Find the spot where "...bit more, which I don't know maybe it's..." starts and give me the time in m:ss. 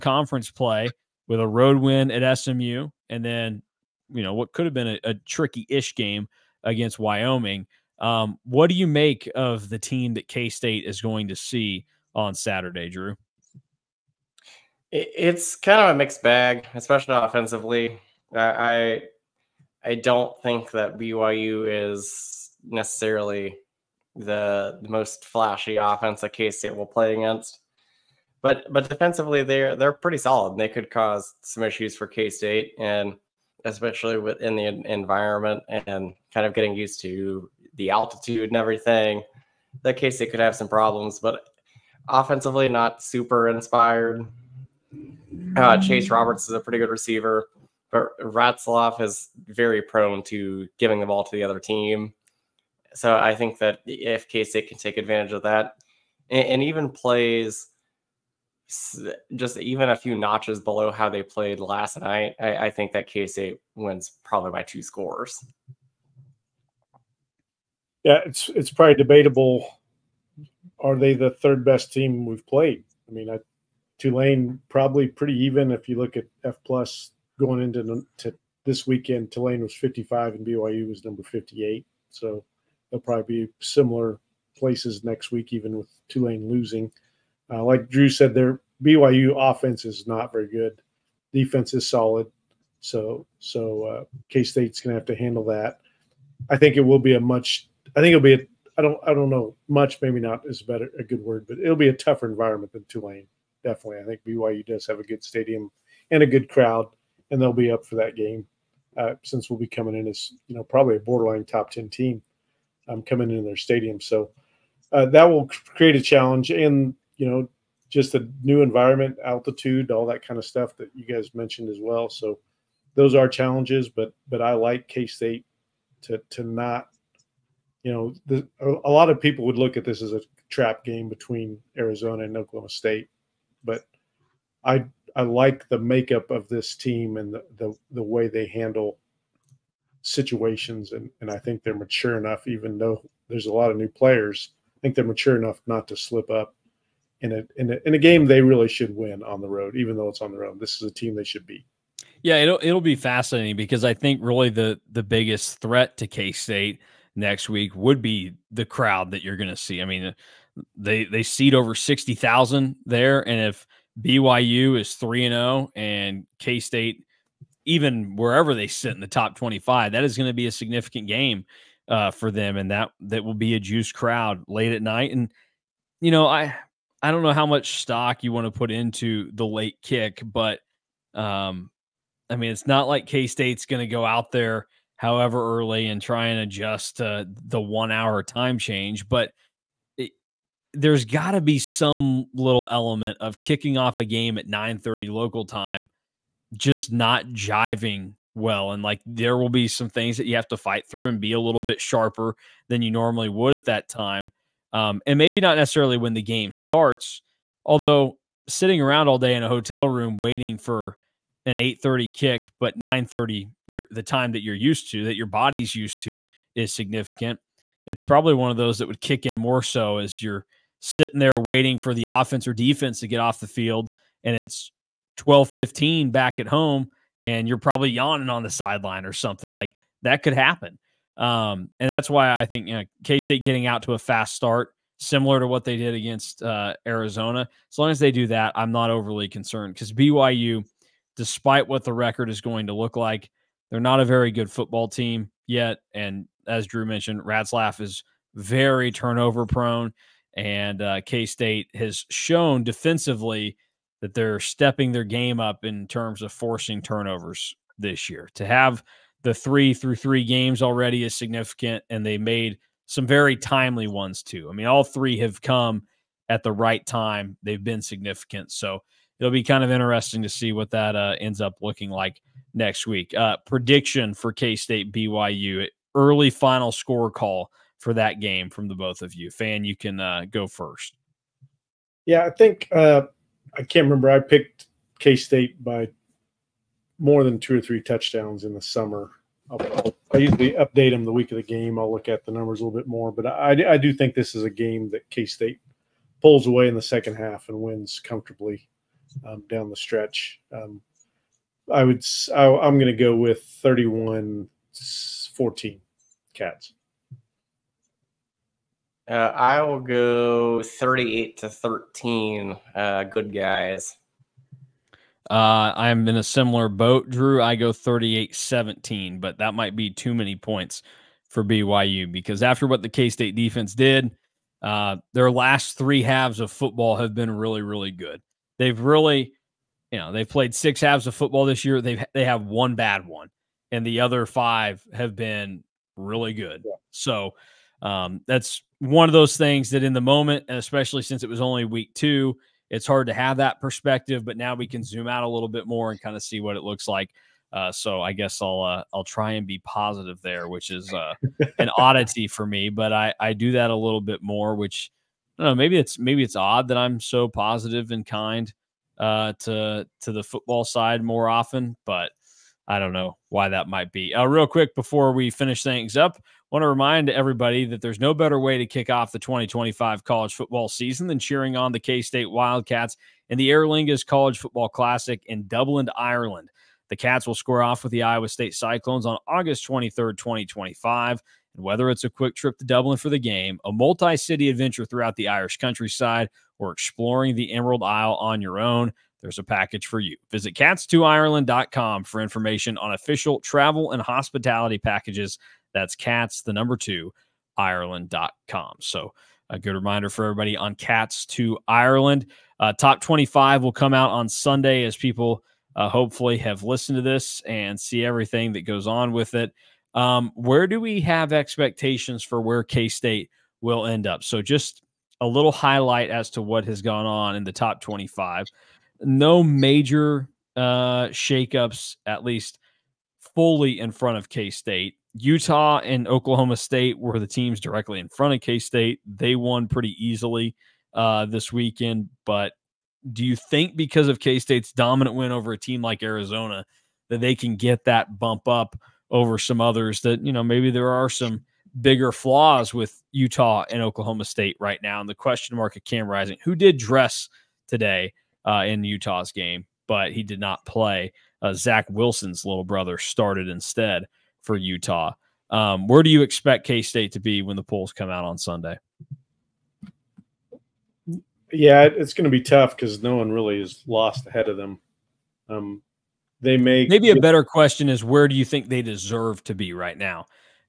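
5:54.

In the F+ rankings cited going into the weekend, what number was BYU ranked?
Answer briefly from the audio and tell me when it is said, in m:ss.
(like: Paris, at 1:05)
58, at 1:21.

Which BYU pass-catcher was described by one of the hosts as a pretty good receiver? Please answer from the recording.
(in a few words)
Chase Roberts.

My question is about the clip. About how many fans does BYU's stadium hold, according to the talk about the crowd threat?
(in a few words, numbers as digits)
over 60,000.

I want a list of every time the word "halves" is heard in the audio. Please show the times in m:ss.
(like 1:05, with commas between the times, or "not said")
5:26, 5:30.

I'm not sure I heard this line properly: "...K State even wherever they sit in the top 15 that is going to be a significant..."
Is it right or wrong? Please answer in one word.
wrong.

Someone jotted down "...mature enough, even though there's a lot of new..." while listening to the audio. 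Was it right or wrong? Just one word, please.
right.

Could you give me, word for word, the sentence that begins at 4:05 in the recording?
And as Drew mentioned, Retzlaff is very turnover prone.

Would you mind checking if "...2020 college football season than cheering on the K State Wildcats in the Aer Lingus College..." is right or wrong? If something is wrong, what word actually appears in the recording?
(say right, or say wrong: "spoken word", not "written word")
wrong: "2025", not "2020".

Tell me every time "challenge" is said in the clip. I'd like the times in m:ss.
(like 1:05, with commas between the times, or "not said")
1:55, 2:03.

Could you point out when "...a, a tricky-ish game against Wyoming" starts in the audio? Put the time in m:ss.
0:04.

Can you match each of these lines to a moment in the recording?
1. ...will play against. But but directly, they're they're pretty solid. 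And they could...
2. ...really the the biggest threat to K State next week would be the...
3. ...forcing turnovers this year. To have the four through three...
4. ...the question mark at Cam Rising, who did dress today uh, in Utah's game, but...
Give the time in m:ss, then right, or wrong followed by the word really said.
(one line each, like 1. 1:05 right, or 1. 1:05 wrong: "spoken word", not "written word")
1. 0:26 wrong: "defensively", not "directly"
2. 2:34 right
3. 4:16 wrong: "three", not "four"
4. 7:25 right.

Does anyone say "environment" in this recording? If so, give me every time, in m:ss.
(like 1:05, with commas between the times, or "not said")
0:34, 1:42, 1:58.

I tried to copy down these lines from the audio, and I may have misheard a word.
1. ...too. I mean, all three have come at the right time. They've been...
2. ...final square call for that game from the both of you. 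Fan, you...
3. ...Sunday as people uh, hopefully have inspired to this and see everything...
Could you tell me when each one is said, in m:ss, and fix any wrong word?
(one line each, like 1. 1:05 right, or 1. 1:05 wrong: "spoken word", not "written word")
1. 4:24 right
2. 4:36 wrong: "score", not "square"
3. 6:44 wrong: "listened", not "inspired".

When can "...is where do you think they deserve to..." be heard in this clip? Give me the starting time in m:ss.
7:47.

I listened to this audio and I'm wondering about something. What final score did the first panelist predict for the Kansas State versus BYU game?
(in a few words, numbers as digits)
31-14.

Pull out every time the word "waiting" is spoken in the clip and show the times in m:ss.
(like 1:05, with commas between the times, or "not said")
3:30, 3:41.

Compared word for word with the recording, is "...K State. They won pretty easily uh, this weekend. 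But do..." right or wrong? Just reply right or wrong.
right.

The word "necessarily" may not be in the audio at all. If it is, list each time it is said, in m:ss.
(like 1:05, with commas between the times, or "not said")
0:22, 3:25.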